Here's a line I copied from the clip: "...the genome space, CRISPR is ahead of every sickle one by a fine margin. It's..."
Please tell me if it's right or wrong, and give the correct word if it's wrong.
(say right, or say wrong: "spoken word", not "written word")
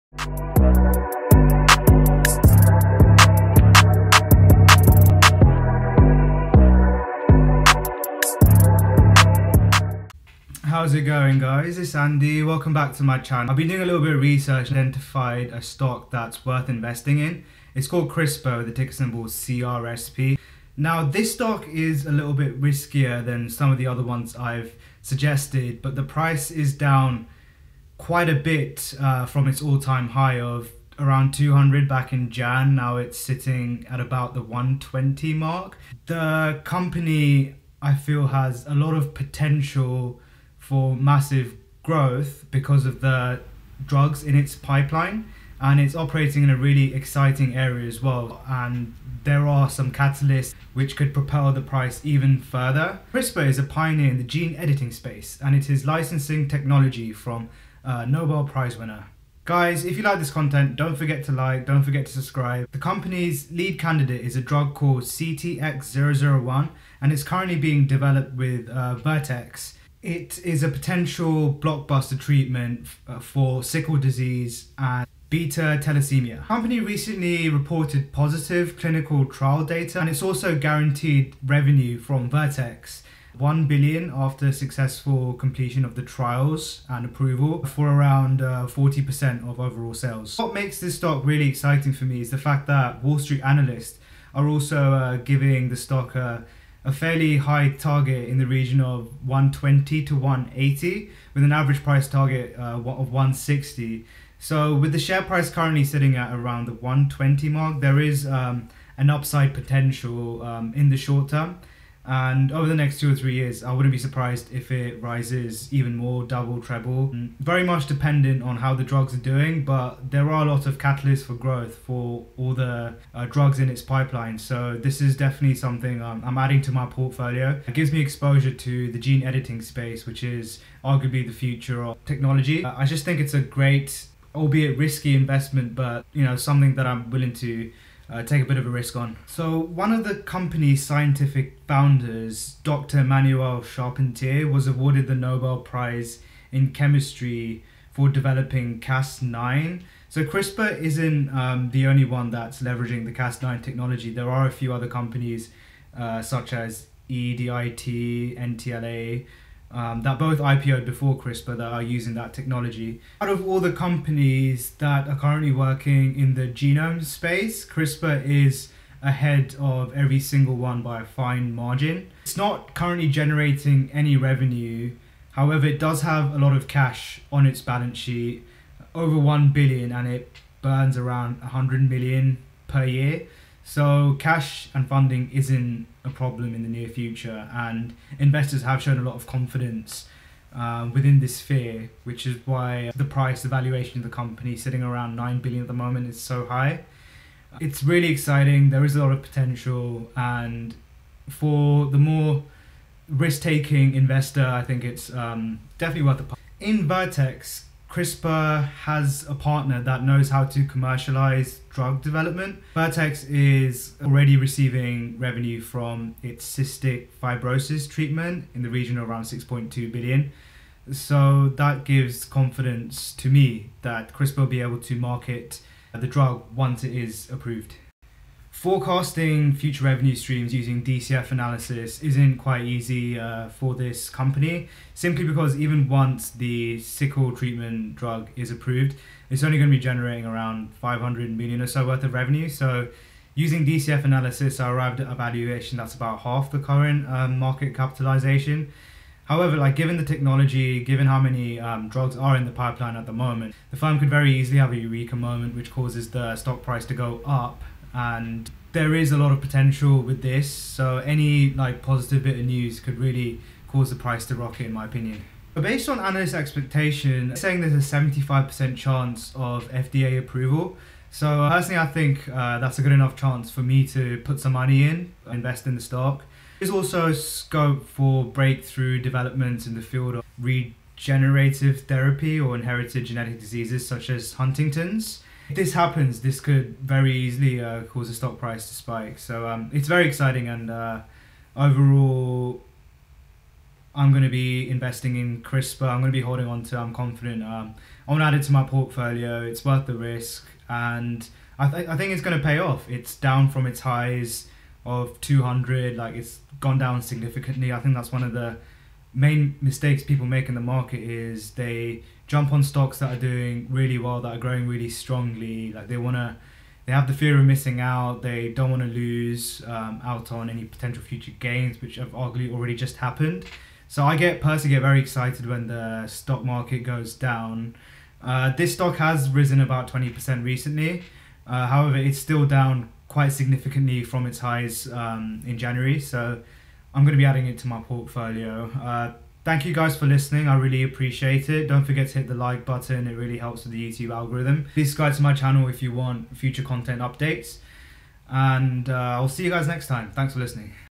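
wrong: "single", not "sickle".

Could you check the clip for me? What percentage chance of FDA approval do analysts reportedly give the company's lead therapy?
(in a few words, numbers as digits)
75%.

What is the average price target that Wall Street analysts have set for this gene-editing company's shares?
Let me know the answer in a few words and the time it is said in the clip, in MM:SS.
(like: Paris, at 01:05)
160, at 01:43.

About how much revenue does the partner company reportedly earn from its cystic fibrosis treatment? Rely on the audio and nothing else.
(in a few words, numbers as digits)
6.2 billion.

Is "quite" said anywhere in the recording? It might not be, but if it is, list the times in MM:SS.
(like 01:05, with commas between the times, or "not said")
00:28, 03:52, 05:33.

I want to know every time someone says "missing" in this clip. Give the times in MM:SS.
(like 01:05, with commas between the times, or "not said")
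05:17.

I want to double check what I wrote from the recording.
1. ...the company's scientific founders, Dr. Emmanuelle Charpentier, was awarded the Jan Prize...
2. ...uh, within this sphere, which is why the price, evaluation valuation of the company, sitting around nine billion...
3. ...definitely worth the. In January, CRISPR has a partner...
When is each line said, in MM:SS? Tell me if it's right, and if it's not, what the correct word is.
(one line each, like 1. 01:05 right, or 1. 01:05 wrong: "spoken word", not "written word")
1. 02:20 wrong: "Nobel", not "Jan"
2. 03:10 right
3. 03:25 wrong: "Vertex", not "January".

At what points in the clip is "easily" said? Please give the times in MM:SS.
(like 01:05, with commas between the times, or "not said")
04:14, 04:47.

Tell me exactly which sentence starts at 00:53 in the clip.
CRISPR is a pioneer in the gene editing space and it is licensing technology from uh, Nobel Prize winner.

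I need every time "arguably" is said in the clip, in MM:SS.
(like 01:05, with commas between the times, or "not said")
02:10, 05:22.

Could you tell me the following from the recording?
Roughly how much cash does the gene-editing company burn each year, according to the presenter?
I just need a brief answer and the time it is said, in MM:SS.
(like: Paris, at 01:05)
100 million, at 03:01.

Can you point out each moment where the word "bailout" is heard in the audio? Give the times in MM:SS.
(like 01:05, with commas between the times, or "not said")
not said.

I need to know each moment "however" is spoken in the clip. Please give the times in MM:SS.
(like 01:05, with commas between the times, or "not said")
02:55, 04:09, 05:31.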